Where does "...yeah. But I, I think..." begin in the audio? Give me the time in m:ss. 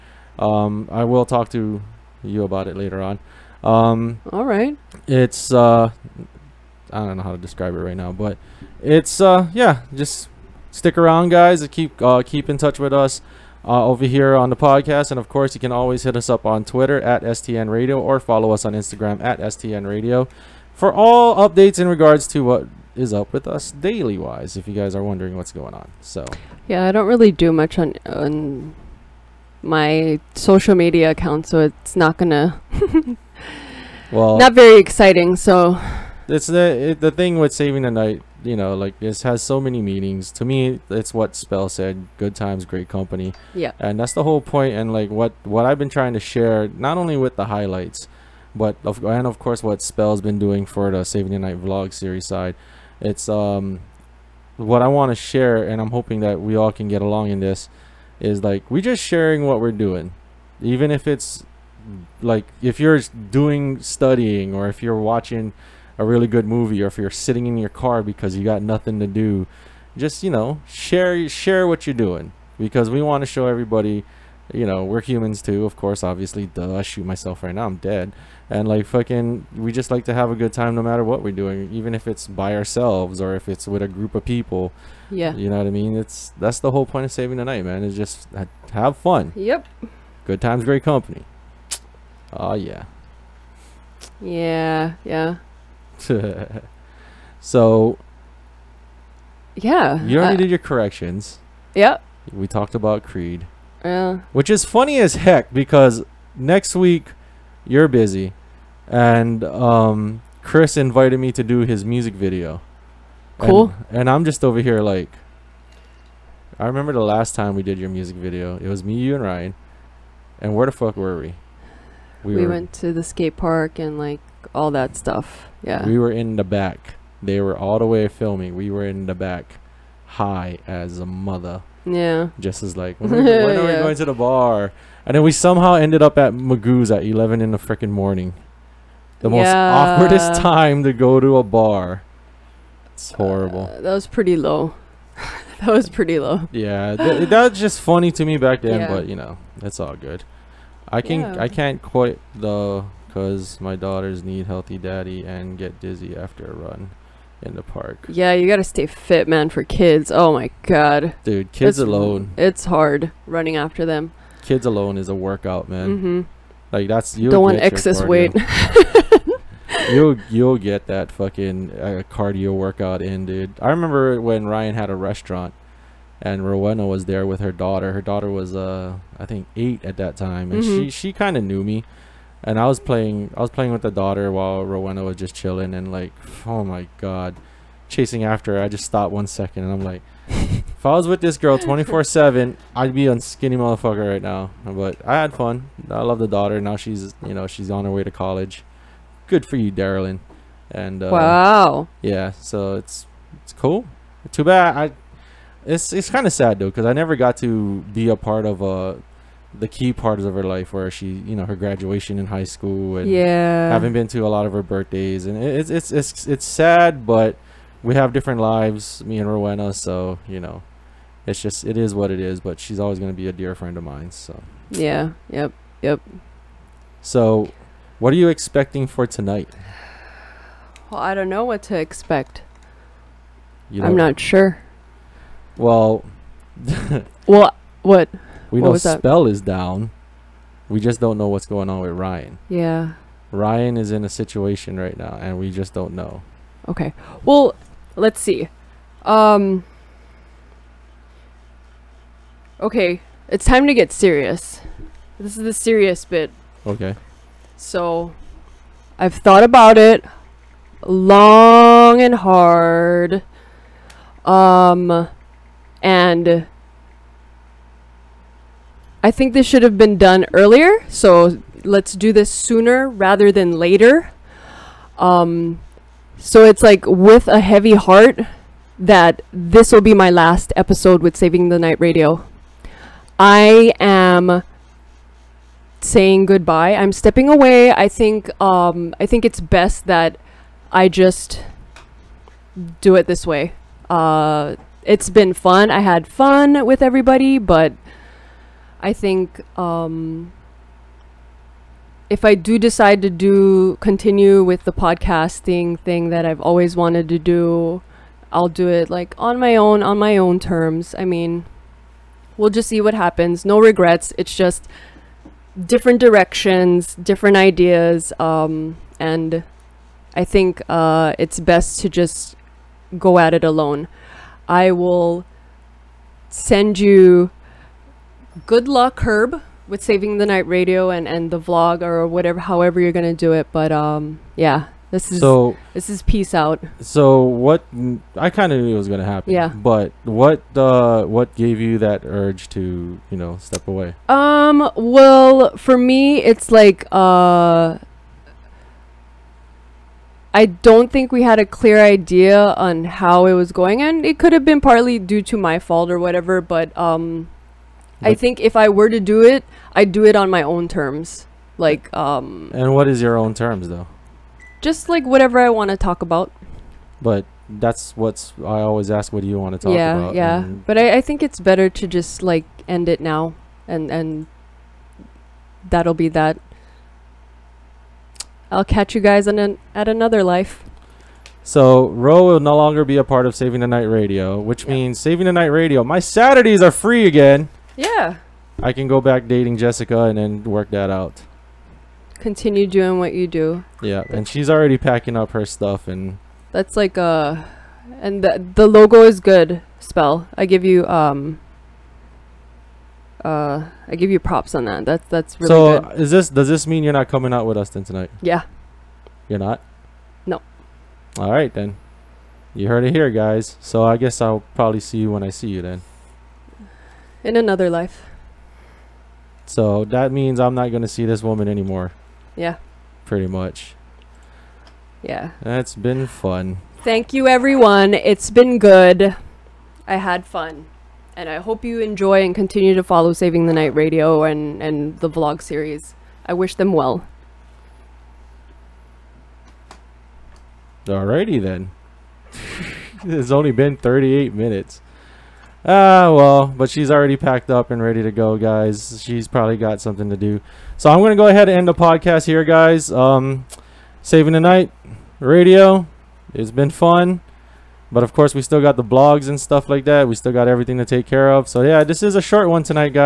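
6:10.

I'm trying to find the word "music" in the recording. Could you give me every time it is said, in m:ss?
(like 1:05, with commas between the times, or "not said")
1:51, 1:57.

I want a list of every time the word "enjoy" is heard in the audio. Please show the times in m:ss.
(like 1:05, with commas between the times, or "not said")
7:11.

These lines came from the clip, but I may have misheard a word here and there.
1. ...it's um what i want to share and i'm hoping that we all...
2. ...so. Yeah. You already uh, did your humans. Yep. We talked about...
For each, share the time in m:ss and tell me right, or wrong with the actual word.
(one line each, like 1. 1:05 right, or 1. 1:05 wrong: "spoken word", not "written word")
1. 0:53 right
2. 1:37 wrong: "corrections", not "humans".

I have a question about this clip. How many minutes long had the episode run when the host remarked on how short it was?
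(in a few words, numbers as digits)
38.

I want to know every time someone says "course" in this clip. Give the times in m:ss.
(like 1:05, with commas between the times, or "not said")
0:15, 0:49, 1:15, 7:38.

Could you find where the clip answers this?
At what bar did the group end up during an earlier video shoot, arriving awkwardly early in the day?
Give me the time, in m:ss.
2:16.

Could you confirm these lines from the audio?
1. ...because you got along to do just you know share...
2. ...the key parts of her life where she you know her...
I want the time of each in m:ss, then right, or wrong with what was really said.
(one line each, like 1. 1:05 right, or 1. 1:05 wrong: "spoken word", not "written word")
1. 1:08 wrong: "nothing", not "along"
2. 3:29 right.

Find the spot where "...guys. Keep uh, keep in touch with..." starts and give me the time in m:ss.
0:11.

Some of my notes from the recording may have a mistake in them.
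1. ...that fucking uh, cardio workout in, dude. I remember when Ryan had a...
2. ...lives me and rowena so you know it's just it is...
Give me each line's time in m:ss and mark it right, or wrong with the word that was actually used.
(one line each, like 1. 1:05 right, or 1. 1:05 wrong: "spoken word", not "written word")
1. 2:50 right
2. 3:38 right.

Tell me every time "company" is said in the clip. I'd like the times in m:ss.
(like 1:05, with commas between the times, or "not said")
0:42, 1:30.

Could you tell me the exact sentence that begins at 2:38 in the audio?
Yeah, you gotta stay fit, man, for kids.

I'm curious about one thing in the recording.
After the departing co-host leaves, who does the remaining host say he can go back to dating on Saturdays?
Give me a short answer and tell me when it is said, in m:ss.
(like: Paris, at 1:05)
Jessica, at 6:29.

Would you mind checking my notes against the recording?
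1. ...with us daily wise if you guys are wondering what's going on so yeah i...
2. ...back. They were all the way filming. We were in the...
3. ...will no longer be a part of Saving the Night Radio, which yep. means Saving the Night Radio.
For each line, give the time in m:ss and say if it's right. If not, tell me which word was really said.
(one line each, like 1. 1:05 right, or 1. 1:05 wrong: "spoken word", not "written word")
1. 0:23 right
2. 2:06 right
3. 6:22 right.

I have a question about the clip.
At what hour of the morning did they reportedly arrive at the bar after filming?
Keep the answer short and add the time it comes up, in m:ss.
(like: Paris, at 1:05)
11, at 2:17.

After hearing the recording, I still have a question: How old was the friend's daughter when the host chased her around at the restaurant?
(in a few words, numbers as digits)
8.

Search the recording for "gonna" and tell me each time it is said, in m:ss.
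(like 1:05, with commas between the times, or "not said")
0:32, 5:32, 5:38.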